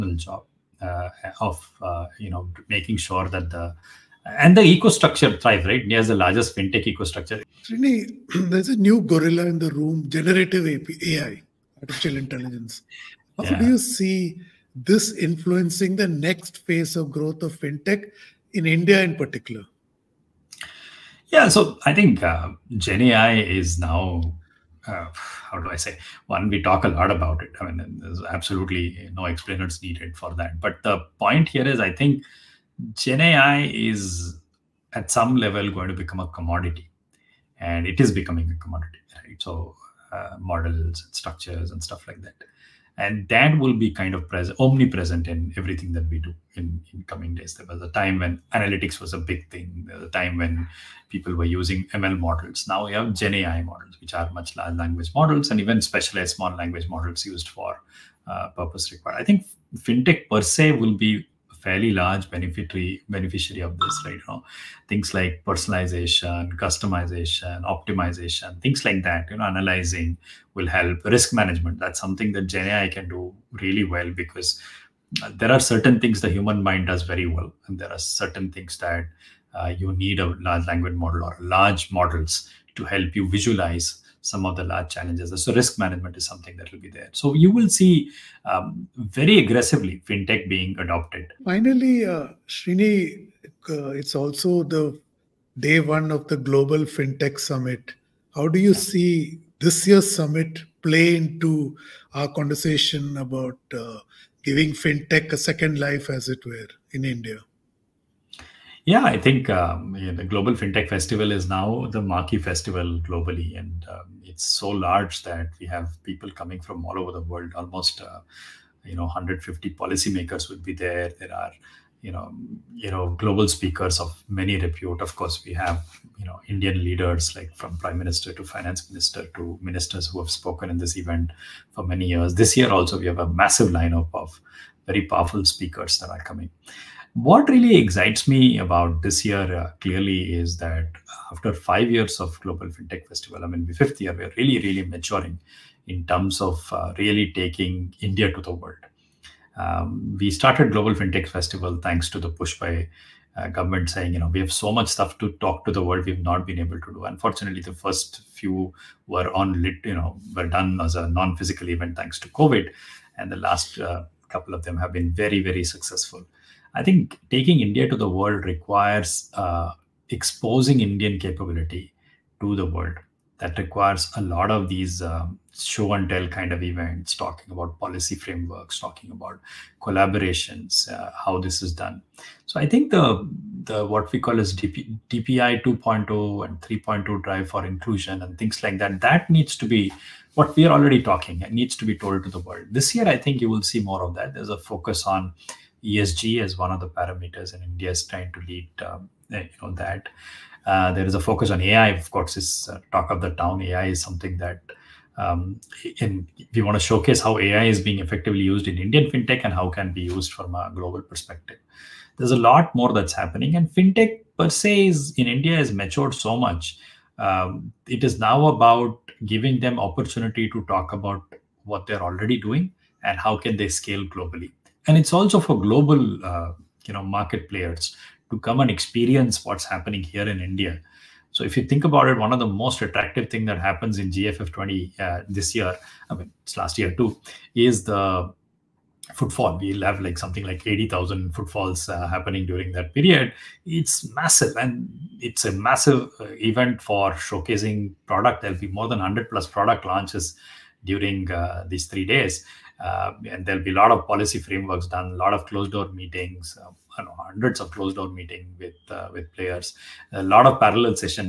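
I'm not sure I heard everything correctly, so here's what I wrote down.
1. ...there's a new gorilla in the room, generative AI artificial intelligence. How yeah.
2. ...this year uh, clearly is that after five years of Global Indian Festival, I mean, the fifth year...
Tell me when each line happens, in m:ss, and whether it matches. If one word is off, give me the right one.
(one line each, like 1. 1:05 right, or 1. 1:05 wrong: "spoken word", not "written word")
1. 0:08 right
2. 2:19 wrong: "FinTech", not "Indian".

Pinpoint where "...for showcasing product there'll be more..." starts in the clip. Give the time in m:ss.
4:06.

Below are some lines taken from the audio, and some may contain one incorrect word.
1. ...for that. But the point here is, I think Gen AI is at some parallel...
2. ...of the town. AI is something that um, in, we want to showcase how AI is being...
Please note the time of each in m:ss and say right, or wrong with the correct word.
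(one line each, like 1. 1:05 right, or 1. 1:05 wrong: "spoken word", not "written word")
1. 0:30 wrong: "level", not "parallel"
2. 3:23 right.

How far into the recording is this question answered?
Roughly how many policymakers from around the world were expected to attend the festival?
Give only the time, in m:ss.
1:59.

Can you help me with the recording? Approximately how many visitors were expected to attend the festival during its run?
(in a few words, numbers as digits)
80,000.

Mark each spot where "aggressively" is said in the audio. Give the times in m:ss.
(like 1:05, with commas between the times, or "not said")
1:29.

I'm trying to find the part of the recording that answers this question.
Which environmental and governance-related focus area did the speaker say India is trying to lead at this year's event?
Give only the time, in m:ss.
3:15.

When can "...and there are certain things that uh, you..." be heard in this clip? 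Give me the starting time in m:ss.
1:17.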